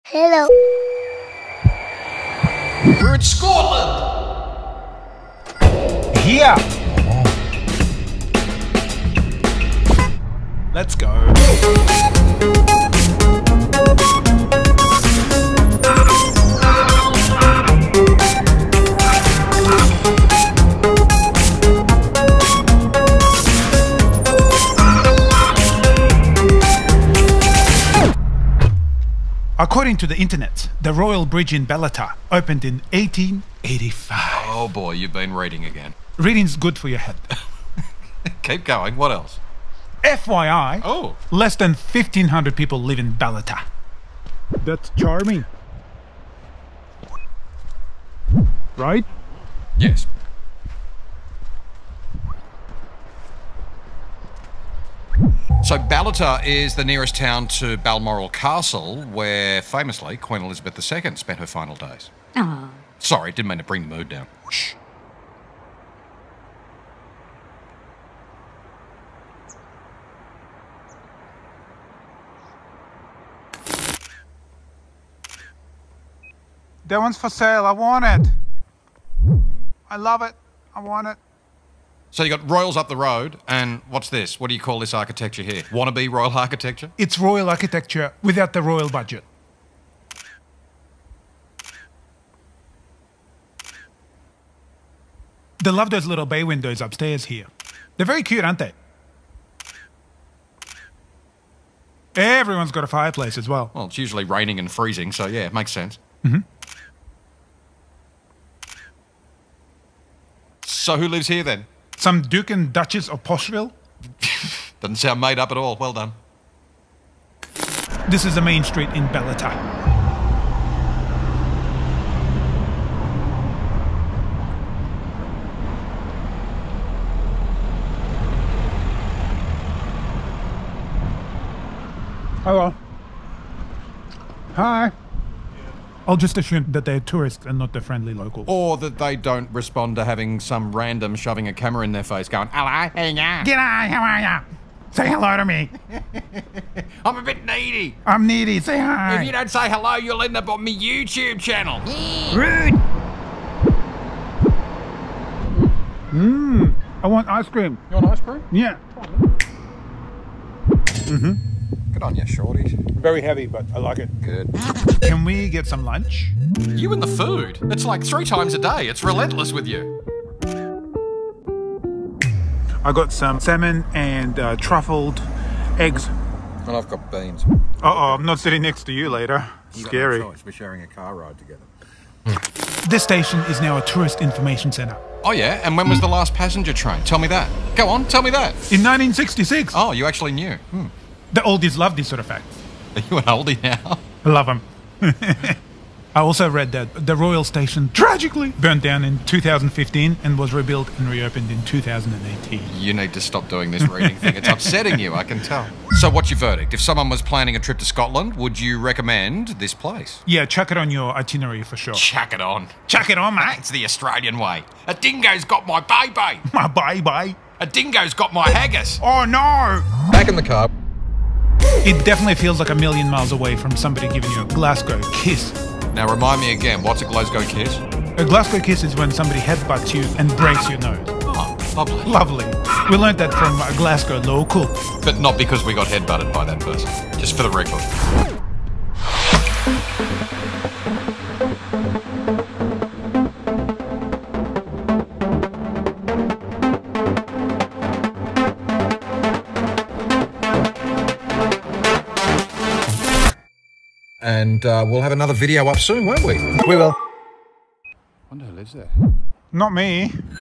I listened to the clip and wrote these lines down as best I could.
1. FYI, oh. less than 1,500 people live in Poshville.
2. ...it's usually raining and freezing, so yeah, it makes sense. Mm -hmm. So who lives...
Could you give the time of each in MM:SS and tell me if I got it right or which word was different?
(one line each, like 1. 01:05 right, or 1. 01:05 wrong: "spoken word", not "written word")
1. 00:40 wrong: "Ballater", not "Poshville"
2. 01:43 right.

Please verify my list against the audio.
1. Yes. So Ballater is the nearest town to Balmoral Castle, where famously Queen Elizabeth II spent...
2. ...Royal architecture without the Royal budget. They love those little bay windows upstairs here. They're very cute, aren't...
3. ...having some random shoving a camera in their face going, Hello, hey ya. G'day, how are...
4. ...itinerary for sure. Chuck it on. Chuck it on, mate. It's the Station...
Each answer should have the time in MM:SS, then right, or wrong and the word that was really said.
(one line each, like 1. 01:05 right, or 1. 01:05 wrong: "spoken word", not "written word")
1. 00:49 right
2. 01:27 right
3. 02:20 right
4. 03:31 wrong: "Australian", not "Station".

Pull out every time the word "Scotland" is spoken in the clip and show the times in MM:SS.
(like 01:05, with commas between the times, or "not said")
00:03, 03:27.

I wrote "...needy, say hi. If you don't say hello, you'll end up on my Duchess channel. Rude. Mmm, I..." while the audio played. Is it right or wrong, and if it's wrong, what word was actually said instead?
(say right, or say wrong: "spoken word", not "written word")
wrong: "YouTube", not "Duchess".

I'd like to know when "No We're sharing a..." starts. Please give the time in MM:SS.
03:00.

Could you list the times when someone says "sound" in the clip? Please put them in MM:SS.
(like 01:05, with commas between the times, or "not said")
01:54.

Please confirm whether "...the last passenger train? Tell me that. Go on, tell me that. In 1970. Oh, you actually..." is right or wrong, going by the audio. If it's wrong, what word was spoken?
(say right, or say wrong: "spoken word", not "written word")
wrong: "1966", not "1970".